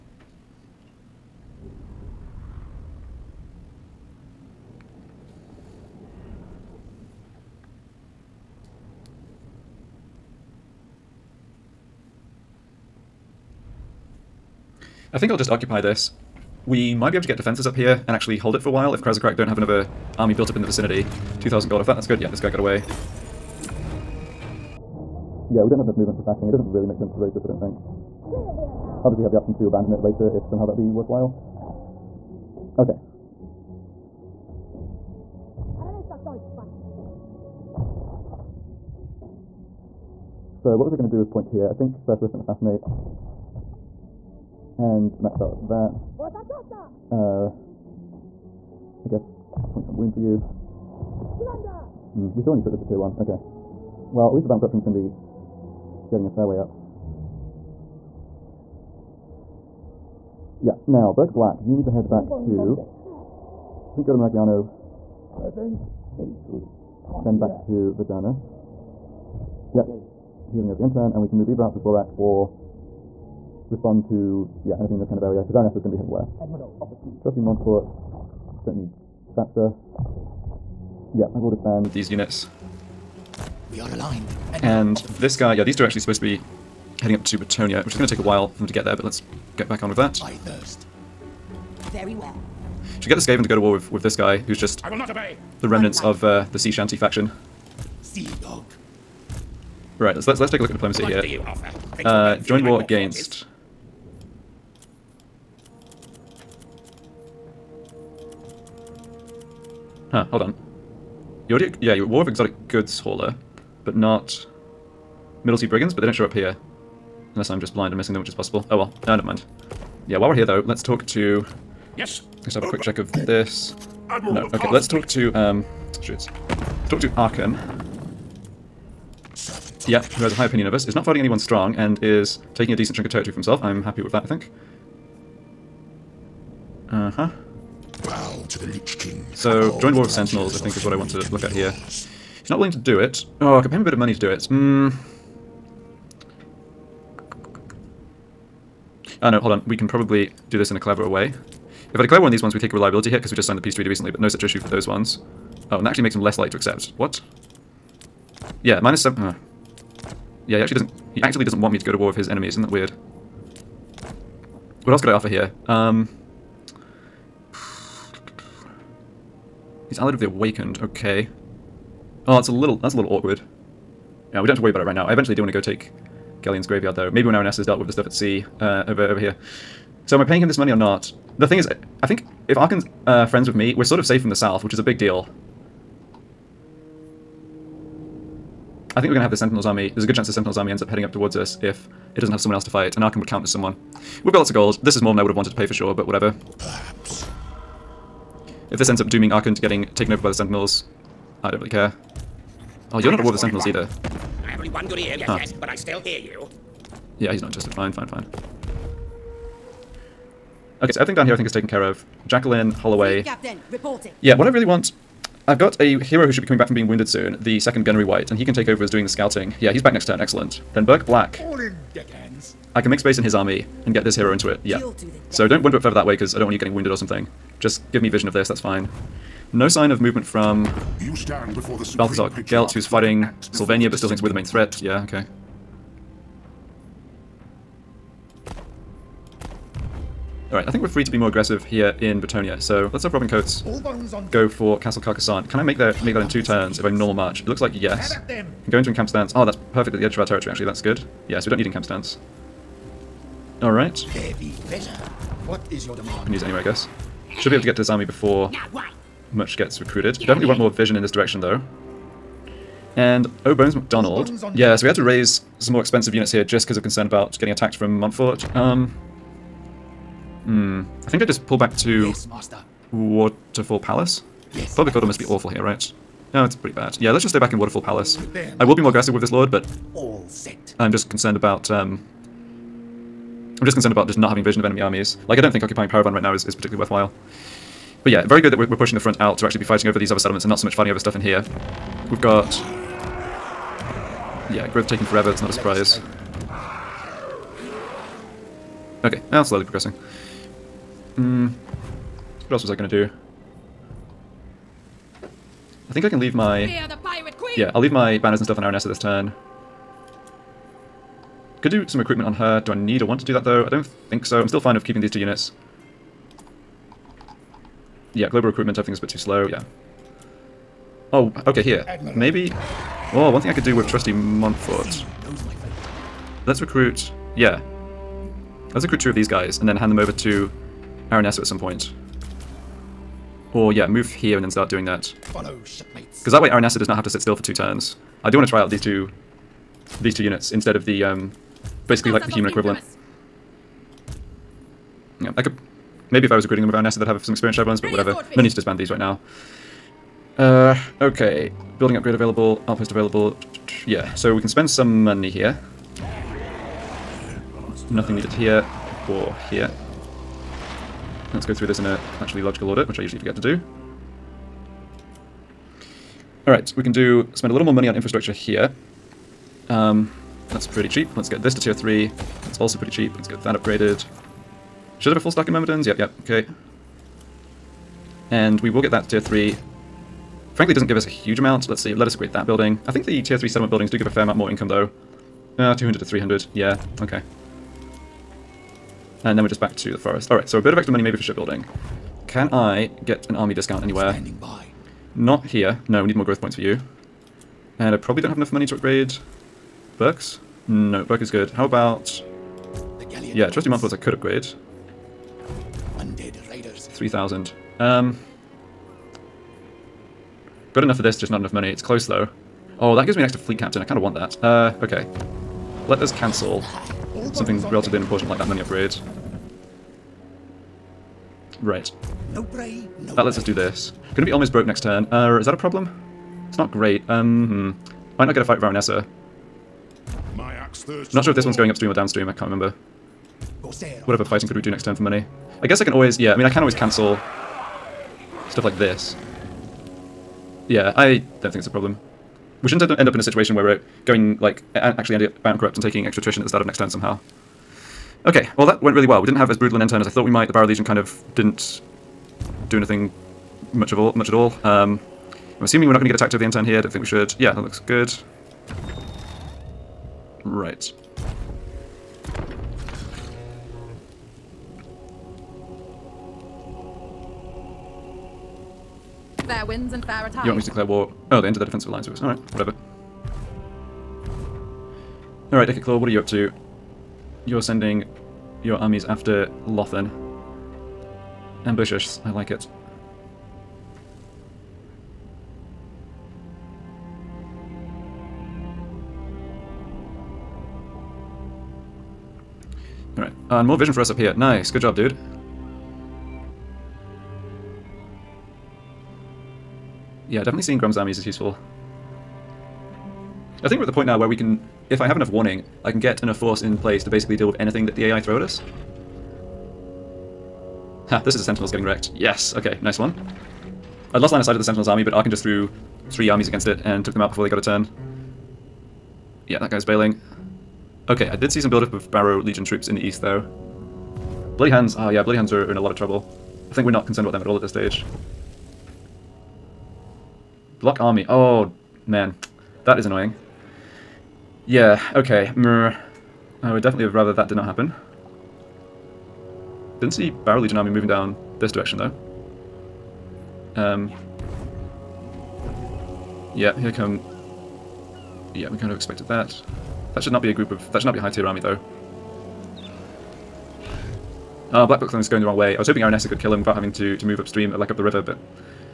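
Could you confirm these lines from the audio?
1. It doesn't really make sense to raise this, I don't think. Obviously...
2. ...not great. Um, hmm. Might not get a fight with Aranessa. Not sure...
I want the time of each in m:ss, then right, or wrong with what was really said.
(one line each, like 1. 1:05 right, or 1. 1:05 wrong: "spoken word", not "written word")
1. 0:26 right
2. 7:06 right.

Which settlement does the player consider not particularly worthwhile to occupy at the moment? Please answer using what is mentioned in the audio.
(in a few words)
Parravon.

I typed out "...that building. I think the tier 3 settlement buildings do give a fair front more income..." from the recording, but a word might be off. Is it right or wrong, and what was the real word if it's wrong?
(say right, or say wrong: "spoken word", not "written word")
wrong: "amount", not "front".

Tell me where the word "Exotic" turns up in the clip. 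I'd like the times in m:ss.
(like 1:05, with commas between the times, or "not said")
1:52.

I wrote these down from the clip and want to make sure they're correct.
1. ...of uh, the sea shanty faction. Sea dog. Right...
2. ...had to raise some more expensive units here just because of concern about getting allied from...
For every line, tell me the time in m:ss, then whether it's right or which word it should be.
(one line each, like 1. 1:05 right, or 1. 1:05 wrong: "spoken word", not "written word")
1. 1:36 right
2. 4:24 wrong: "attacked", not "allied".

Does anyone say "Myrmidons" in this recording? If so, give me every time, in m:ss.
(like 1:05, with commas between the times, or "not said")
6:15.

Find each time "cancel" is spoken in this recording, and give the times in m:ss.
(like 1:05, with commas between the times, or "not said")
6:56, 7:16.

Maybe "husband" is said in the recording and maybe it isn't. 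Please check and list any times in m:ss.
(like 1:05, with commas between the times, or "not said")
not said.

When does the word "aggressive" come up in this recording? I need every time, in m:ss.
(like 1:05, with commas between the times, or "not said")
4:01, 4:38.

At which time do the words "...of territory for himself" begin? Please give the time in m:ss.
2:13.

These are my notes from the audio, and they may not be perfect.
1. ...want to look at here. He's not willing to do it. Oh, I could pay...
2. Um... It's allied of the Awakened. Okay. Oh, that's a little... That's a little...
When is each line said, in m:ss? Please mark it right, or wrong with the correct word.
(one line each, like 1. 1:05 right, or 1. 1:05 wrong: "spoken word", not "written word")
1. 2:20 right
2. 2:45 right.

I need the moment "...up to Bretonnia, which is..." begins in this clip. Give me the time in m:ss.
1:27.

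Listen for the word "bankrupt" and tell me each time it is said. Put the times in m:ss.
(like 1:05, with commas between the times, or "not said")
7:25.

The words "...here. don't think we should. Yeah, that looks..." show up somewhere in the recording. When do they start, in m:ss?
7:36.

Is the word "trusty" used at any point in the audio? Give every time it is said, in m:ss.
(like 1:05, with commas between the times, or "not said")
1:17, 5:23, 6:43.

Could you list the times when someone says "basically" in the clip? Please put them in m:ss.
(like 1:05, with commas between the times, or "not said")
5:41, 8:27.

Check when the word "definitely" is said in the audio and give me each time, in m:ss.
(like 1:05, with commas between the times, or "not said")
4:20, 8:20, 8:56.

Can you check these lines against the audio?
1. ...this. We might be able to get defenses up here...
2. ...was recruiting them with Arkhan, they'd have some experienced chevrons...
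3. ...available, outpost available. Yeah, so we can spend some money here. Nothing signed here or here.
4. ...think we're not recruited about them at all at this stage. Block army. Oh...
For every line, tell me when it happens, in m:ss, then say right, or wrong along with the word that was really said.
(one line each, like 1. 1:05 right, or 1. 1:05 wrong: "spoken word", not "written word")
1. 0:15 right
2. 5:46 wrong: "Aranessa", not "Arkhan"
3. 5:52 wrong: "needed", not "signed"
4. 8:46 wrong: "concerned", not "recruited".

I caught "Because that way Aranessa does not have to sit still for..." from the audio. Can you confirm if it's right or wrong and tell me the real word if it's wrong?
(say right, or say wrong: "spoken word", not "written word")
right.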